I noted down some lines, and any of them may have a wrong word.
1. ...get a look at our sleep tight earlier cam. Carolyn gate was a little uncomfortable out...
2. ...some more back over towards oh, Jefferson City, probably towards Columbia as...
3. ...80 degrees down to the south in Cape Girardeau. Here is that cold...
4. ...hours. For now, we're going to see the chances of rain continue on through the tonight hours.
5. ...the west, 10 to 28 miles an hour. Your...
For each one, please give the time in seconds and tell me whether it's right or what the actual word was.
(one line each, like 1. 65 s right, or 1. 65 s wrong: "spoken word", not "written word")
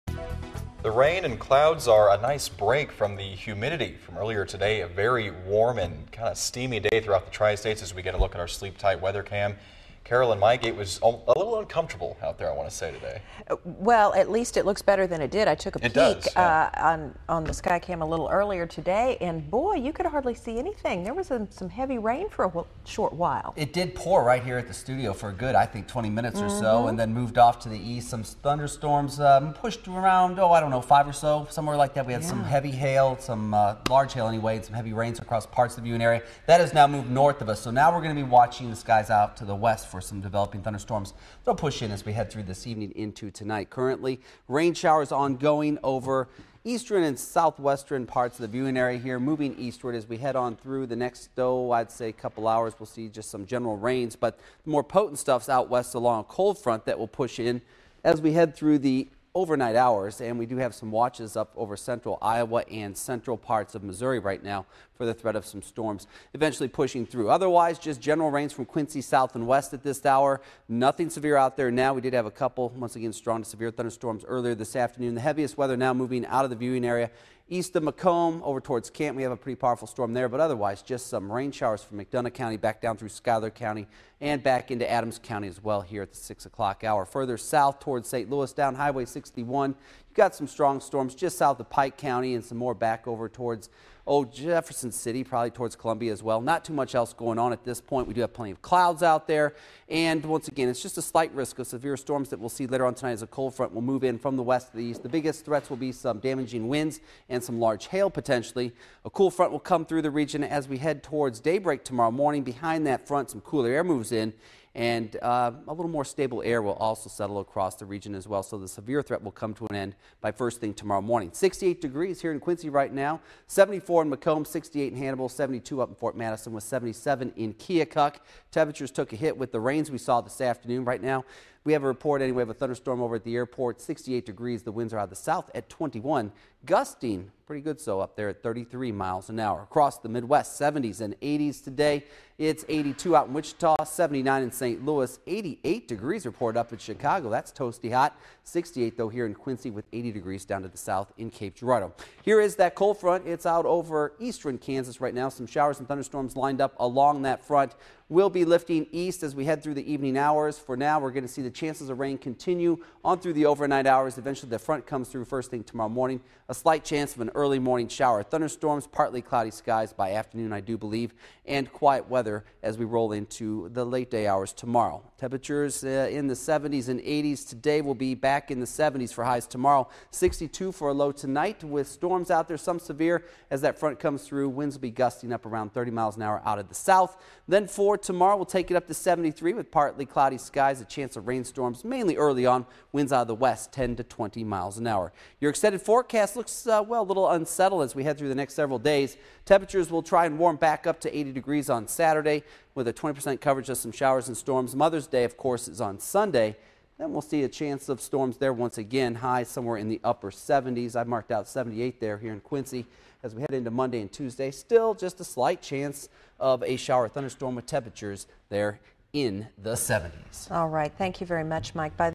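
1. 8 s wrong: "weather", not "earlier"
2. 92 s right
3. 149 s right
4. 160 s wrong: "overnight", not "tonight"
5. 193 s wrong: "20", not "28".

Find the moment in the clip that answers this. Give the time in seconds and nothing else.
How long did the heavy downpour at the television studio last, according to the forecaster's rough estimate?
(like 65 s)
25 s.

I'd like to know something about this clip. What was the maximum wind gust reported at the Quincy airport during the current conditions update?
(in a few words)
33 mph.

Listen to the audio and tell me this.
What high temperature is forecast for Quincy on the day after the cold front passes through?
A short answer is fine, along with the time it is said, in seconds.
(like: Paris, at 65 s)
73, at 188 s.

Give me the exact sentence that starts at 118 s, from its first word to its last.
So the severe threat will come to an end by first thing tomorrow morning.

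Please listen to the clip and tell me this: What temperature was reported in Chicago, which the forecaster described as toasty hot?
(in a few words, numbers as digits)
88 degrees.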